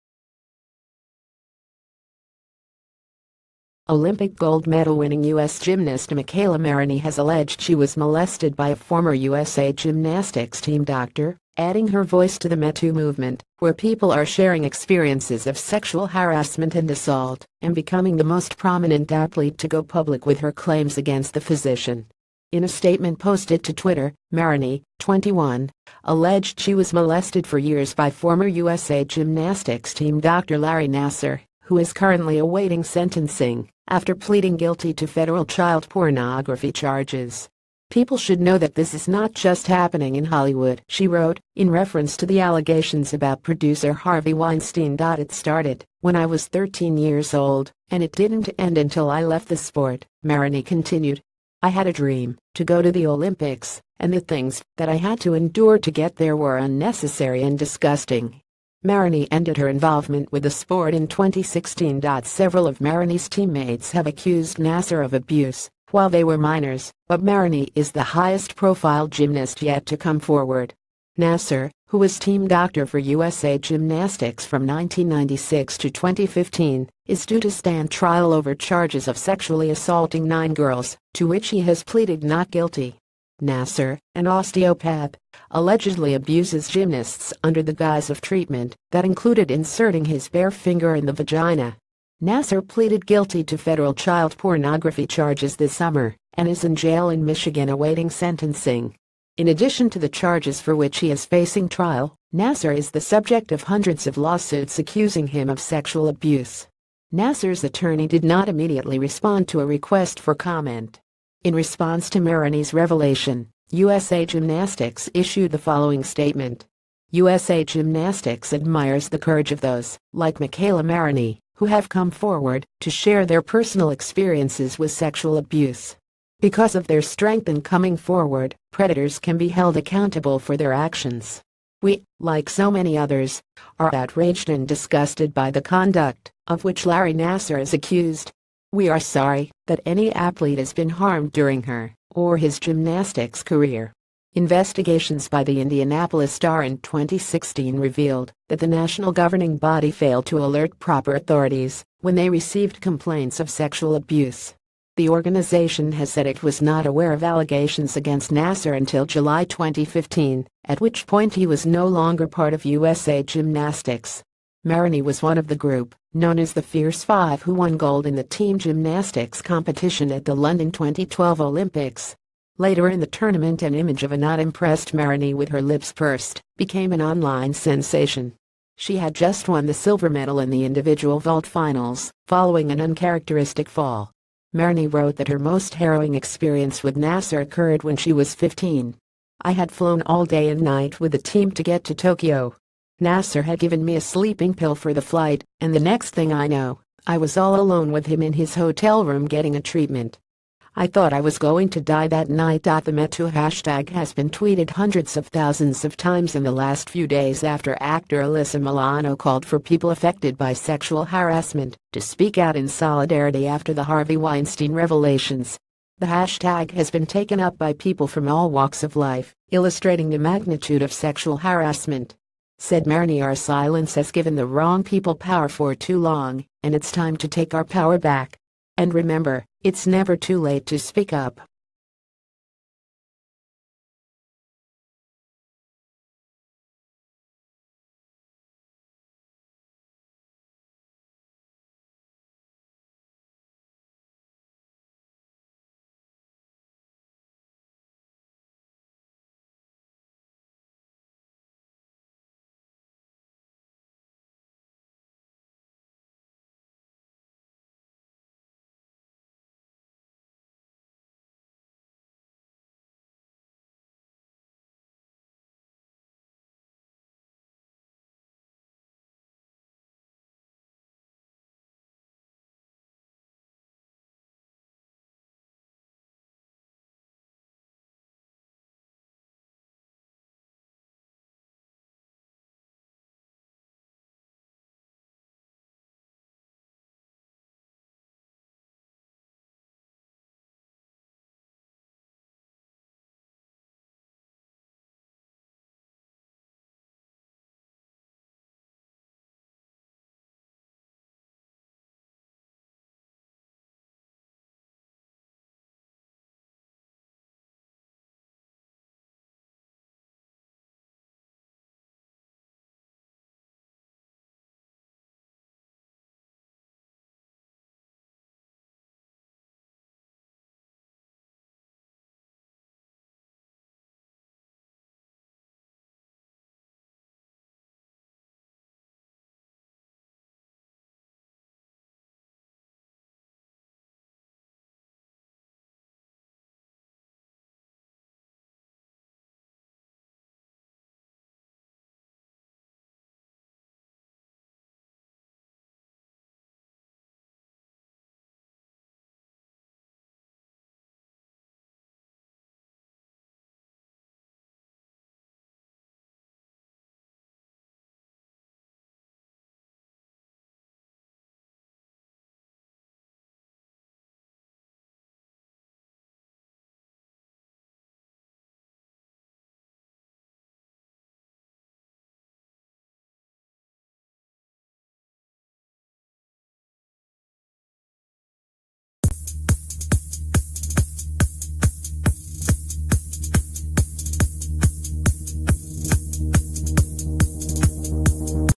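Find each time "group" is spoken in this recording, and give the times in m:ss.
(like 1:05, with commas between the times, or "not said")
2:45.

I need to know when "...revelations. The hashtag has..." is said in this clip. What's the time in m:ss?
3:34.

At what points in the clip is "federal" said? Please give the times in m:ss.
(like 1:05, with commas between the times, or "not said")
0:35, 1:33.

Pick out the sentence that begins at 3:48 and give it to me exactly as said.
And remember, it's never too late to speak up.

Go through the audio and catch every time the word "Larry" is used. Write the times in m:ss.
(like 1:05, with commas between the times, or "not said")
0:30, 2:16.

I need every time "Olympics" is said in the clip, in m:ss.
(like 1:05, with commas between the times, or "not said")
0:03, 0:53, 2:51.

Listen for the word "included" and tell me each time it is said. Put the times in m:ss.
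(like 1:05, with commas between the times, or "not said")
1:29.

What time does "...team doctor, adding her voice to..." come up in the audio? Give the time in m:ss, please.
0:10.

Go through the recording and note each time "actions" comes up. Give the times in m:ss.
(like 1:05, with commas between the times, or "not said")
2:10.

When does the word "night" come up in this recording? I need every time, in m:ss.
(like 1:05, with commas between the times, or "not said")
3:10, 3:22.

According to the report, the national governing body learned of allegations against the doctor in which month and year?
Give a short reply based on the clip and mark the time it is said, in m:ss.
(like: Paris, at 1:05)
July 2015, at 2:39.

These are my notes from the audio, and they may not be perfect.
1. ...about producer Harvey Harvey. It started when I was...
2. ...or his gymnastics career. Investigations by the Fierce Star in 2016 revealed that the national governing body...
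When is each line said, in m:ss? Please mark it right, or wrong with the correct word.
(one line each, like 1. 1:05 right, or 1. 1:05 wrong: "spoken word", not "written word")
1. 0:43 wrong: "Weinstein", not "Harvey"
2. 2:22 wrong: "Indianapolis", not "Fierce".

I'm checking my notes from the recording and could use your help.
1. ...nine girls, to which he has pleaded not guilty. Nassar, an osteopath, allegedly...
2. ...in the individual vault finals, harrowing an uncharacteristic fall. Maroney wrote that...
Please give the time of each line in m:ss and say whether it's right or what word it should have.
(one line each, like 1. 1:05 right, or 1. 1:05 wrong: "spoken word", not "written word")
1. 1:20 right
2. 3:00 wrong: "following", not "harrowing".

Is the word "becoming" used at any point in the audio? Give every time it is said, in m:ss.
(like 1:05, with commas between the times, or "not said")
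0:17.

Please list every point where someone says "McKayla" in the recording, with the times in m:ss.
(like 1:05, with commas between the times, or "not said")
0:06, 2:00.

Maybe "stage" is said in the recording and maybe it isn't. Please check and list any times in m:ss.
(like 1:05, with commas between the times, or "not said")
not said.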